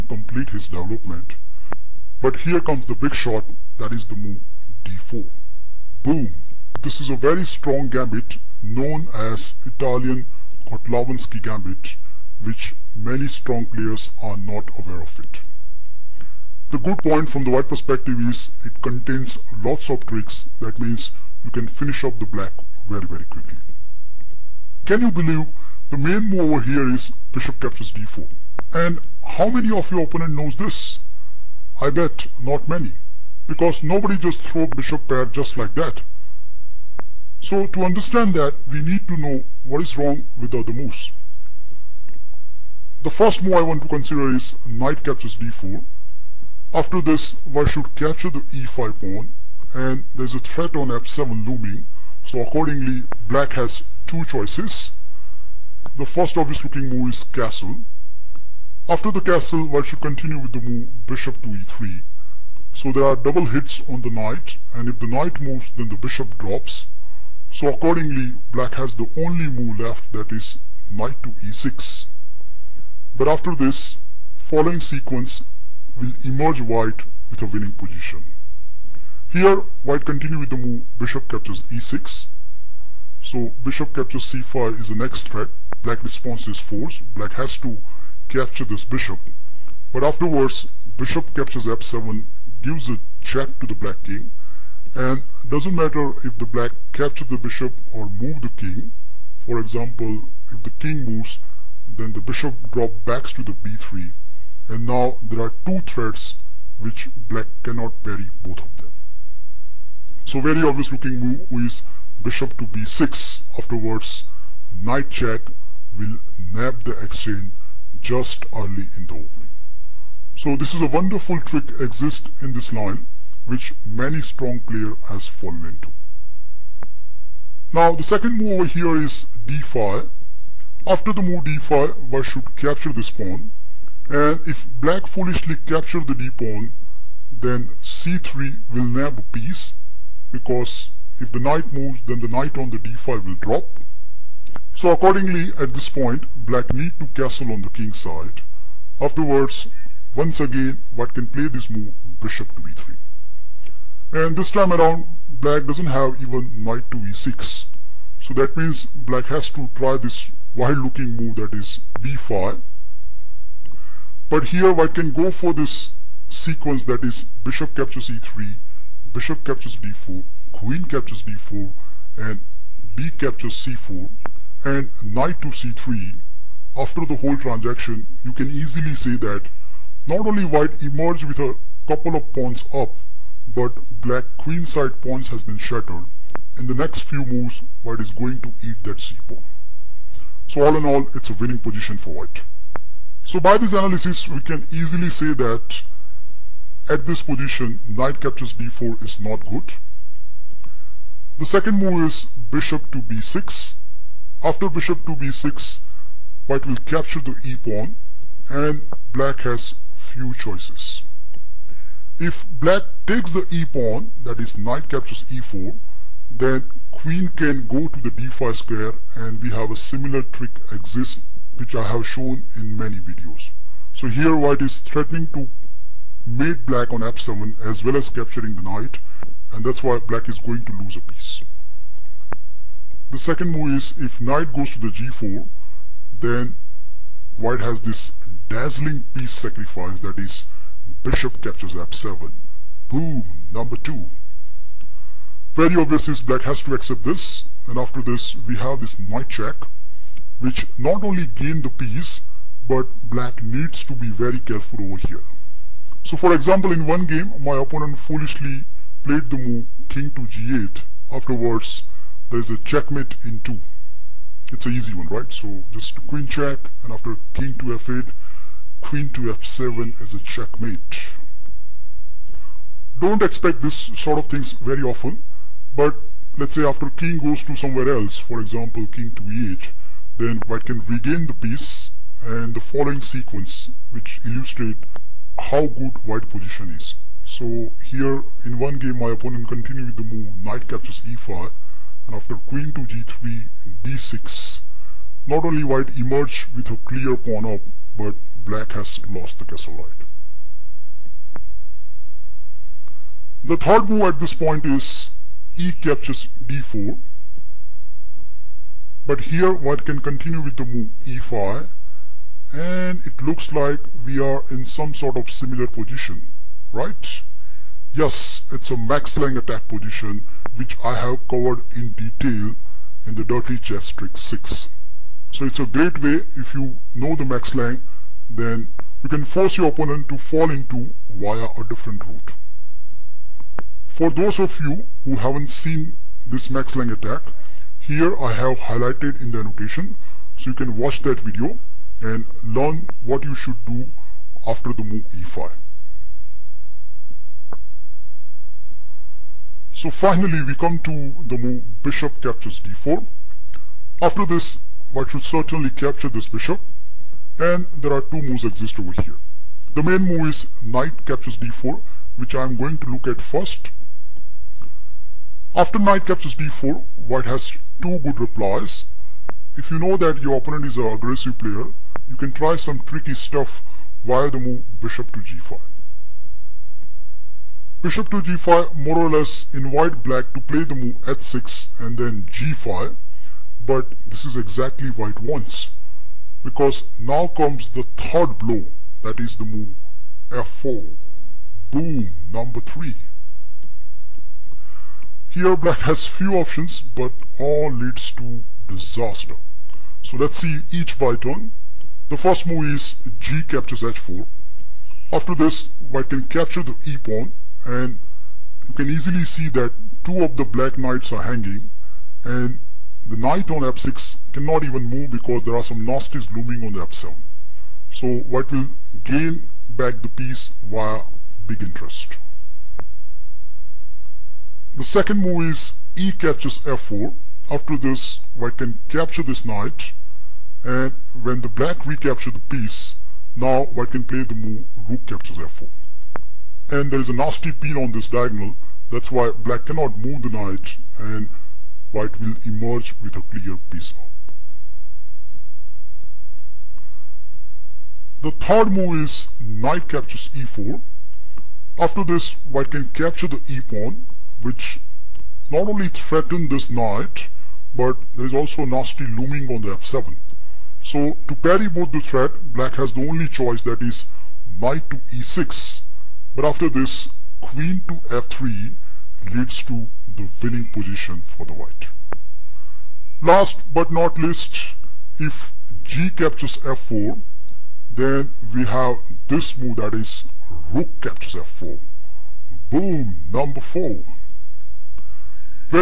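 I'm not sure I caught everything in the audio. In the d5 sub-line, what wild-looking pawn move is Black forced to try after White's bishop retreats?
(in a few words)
b5.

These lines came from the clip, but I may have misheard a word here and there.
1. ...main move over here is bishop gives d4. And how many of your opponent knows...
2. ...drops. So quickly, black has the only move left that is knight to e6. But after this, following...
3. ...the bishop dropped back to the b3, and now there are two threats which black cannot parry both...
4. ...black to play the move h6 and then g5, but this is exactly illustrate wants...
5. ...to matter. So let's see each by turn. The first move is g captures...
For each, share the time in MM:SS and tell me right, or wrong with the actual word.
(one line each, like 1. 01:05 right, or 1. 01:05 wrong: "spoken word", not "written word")
1. 00:25 wrong: "captures", not "gives"
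2. 01:06 wrong: "accordingly", not "quickly"
3. 01:42 right
4. 06:20 wrong: "white", not "illustrate"
5. 06:38 wrong: "disaster", not "matter".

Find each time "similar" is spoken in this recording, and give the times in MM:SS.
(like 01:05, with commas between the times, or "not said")
03:39, 05:15.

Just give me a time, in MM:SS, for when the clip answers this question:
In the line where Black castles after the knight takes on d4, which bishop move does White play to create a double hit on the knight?
01:01.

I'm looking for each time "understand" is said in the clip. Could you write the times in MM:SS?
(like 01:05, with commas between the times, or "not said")
00:37.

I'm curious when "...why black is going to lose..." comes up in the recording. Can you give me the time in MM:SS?
03:49.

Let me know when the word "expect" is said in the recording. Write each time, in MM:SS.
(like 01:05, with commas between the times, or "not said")
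04:33.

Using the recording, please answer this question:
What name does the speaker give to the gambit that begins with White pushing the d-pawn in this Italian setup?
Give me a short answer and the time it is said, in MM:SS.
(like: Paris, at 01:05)
Italian Kotlavinsky gambit, at 00:09.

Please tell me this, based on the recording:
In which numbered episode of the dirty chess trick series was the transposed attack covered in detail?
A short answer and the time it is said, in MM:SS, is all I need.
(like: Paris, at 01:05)
6, at 05:24.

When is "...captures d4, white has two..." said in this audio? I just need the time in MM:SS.
06:06.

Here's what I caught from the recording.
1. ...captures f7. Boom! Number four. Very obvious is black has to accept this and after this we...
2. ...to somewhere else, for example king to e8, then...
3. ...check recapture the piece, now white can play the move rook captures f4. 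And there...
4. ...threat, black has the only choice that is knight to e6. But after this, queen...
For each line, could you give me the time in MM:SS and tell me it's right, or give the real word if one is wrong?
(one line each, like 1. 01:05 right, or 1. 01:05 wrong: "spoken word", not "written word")
1. 04:01 wrong: "two", not "four"
2. 04:37 right
3. 07:11 wrong: "black", not "check"
4. 07:41 right.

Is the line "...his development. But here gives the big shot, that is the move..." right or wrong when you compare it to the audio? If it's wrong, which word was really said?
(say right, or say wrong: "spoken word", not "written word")
wrong: "comes", not "gives".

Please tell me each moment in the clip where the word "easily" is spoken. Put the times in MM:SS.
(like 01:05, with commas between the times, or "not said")
02:58, 03:14, 06:48.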